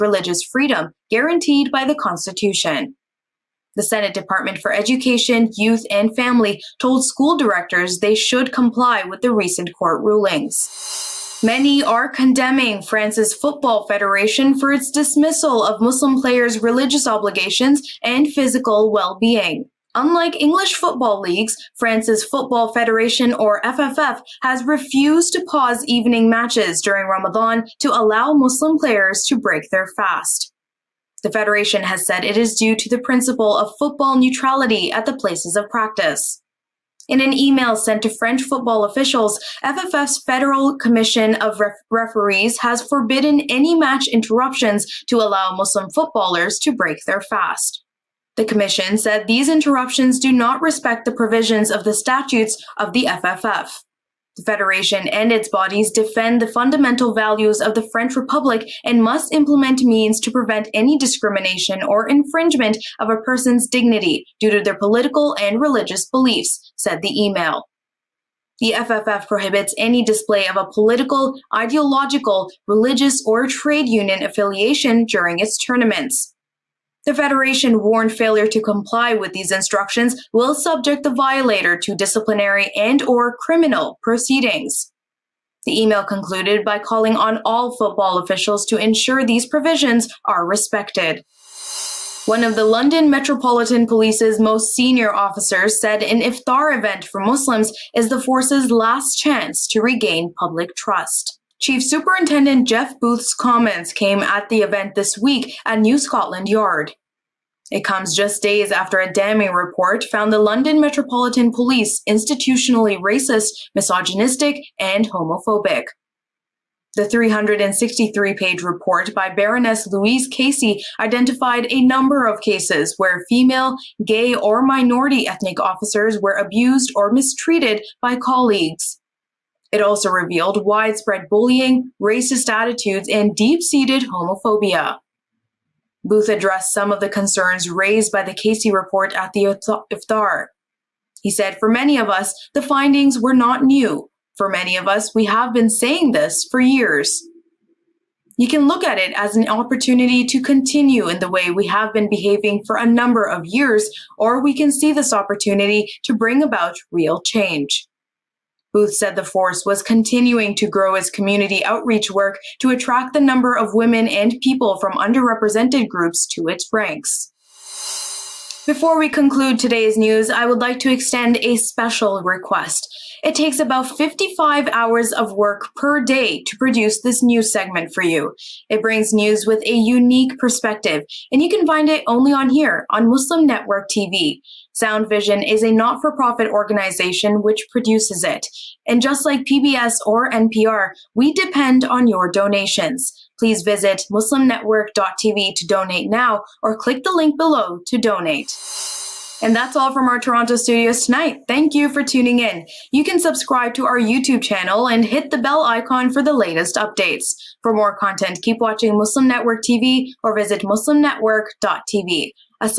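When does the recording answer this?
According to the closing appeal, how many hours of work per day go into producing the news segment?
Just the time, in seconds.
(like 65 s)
173 s.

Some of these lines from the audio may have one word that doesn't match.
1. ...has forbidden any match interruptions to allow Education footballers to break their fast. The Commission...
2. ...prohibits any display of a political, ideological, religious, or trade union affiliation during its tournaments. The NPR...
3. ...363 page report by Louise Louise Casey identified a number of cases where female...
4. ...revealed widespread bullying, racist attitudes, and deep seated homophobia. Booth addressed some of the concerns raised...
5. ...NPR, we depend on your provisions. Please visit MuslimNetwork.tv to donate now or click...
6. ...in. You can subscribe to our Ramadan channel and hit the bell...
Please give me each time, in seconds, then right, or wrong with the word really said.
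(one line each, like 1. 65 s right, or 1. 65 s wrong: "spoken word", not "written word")
1. 42 s wrong: "Muslim", not "Education"
2. 69 s wrong: "Federation", not "NPR"
3. 117 s wrong: "Baroness", not "Louise"
4. 130 s right
5. 190 s wrong: "donations", not "provisions"
6. 202 s wrong: "YouTube", not "Ramadan".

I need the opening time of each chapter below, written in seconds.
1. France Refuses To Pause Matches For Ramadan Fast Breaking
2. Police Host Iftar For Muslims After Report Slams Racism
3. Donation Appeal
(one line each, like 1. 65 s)
1. 10 s
2. 90 s
3. 167 s.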